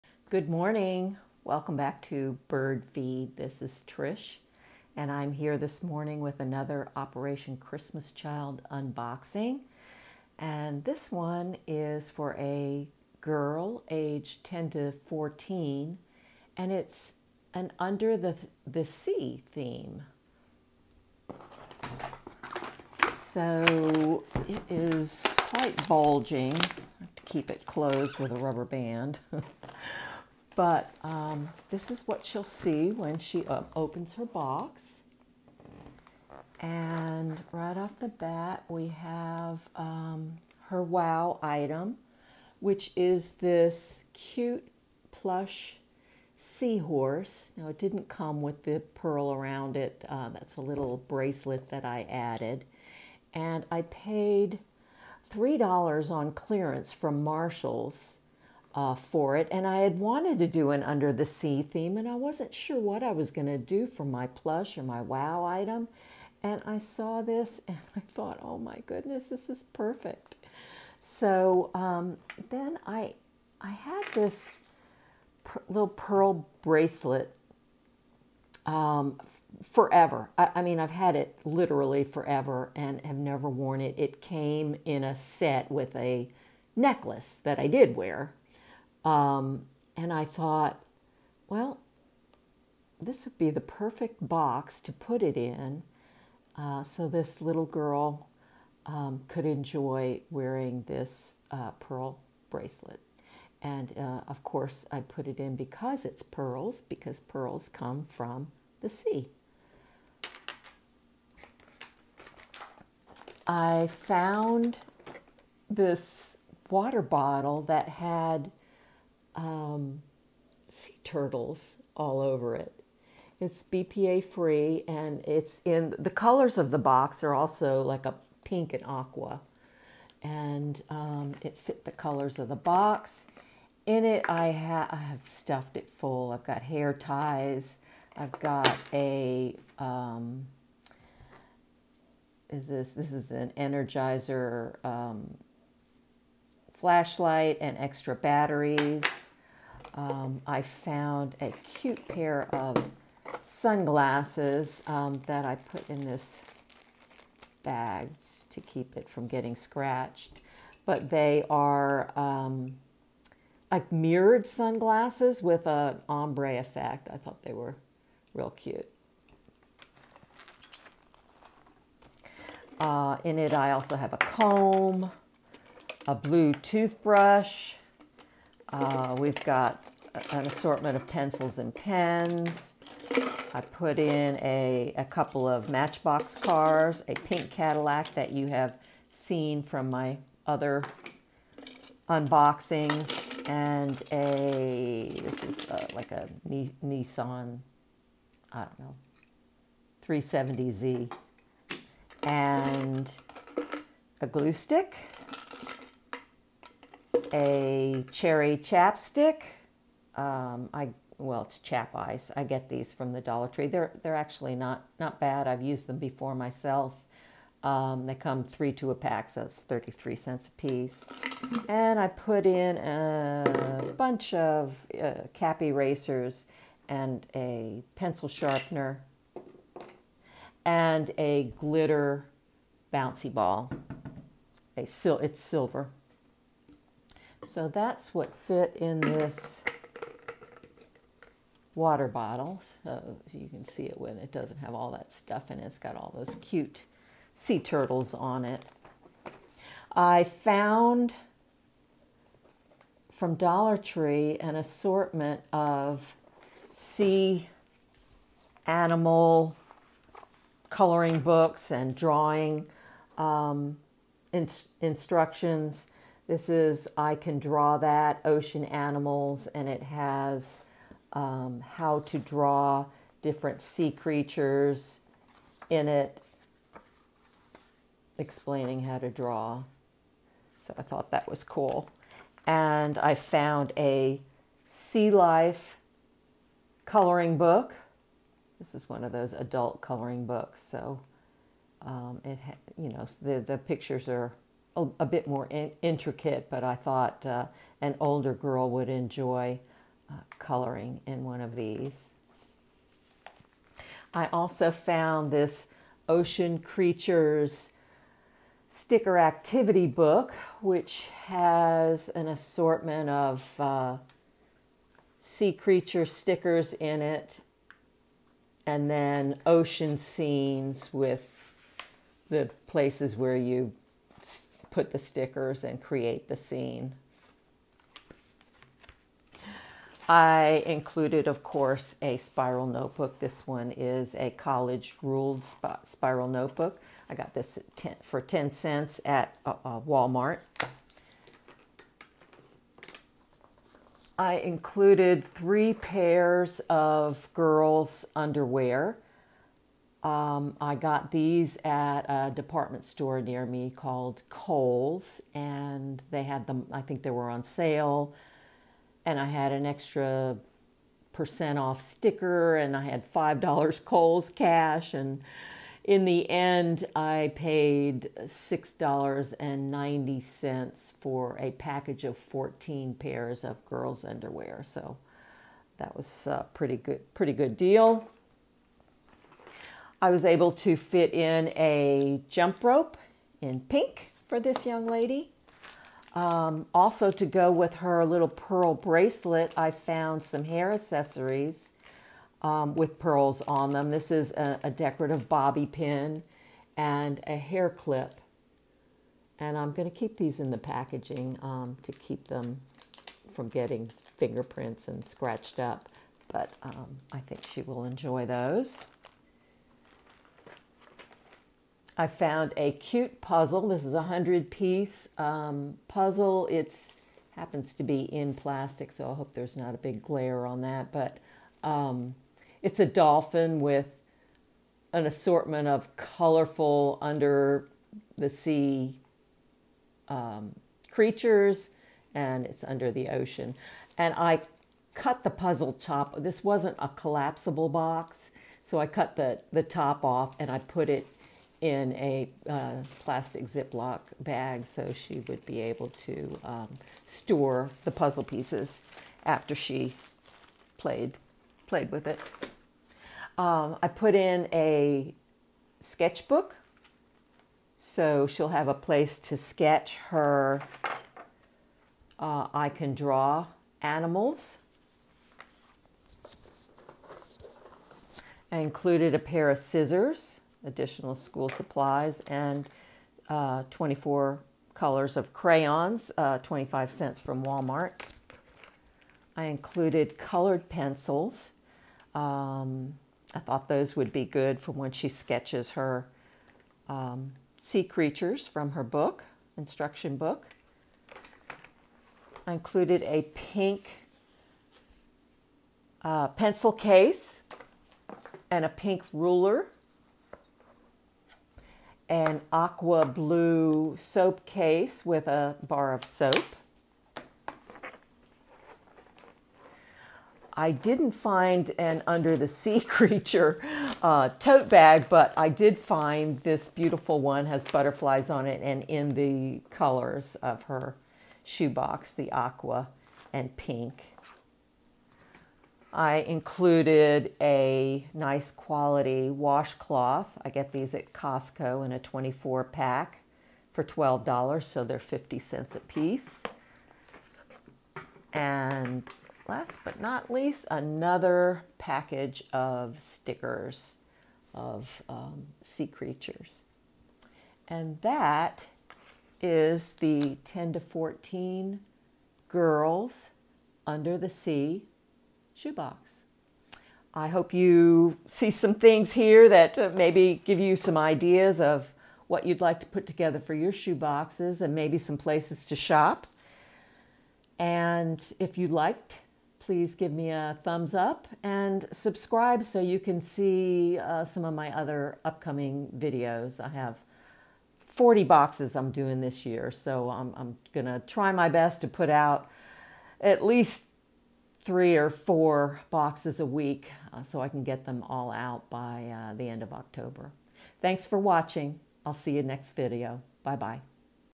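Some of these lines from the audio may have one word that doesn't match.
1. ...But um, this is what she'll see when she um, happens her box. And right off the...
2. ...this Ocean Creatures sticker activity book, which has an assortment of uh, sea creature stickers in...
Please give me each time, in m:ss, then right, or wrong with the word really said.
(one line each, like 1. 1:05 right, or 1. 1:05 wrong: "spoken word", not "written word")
1. 0:30 wrong: "opens", not "happens"
2. 5:05 right.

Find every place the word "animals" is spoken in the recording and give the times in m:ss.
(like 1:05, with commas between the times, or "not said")
4:18, 4:28, 7:43.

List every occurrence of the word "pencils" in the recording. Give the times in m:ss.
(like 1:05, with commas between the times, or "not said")
3:01, 3:47, 8:00, 8:16.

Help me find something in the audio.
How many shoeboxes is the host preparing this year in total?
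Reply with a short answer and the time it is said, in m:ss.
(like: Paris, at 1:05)
40, at 9:37.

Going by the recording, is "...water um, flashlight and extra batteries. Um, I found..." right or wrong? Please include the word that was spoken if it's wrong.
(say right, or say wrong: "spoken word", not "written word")
wrong: "energizer", not "water".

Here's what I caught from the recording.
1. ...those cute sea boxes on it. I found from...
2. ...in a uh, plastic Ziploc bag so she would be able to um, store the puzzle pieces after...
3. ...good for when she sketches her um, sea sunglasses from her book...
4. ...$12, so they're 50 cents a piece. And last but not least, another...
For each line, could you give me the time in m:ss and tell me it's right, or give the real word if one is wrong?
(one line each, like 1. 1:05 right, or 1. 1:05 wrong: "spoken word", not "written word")
1. 4:06 wrong: "turtles", not "boxes"
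2. 7:21 right
3. 8:04 wrong: "creatures", not "sunglasses"
4. 8:53 right.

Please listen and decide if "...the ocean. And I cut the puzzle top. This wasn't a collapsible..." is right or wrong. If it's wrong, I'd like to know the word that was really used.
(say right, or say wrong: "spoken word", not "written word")
right.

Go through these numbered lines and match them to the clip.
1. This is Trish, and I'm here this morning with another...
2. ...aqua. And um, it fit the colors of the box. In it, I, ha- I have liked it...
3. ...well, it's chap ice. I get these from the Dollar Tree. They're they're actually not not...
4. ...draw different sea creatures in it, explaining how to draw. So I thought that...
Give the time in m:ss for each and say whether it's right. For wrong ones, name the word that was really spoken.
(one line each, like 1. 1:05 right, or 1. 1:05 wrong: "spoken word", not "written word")
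1. 0:03 right
2. 2:08 wrong: "stuffed", not "liked"
3. 3:31 right
4. 4:32 right.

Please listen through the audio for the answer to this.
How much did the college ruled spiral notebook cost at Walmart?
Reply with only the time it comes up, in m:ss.
5:38.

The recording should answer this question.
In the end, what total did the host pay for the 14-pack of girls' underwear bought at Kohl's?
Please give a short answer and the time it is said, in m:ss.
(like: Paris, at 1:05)
$6.90, at 6:08.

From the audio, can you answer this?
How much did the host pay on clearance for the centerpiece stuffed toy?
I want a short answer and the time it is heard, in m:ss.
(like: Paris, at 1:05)
$3 at Marshall's, at 0:55.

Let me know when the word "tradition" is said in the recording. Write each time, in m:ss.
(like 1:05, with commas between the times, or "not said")
not said.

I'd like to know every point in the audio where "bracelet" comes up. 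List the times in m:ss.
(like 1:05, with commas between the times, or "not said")
0:50, 1:16, 1:42, 6:28.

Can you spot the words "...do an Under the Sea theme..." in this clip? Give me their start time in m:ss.
1:00.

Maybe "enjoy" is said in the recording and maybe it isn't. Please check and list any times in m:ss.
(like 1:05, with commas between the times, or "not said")
1:39, 4:58, 6:47.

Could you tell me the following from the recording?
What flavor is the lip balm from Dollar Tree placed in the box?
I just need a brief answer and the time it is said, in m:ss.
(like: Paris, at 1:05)
Cherry, at 3:28.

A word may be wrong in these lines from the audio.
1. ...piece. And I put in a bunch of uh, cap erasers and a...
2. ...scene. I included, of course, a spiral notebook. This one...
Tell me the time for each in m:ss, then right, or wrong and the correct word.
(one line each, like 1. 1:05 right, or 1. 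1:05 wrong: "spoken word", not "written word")
1. 3:40 right
2. 5:26 right.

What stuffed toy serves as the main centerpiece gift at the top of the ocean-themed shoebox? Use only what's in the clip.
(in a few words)
Plush seahorse.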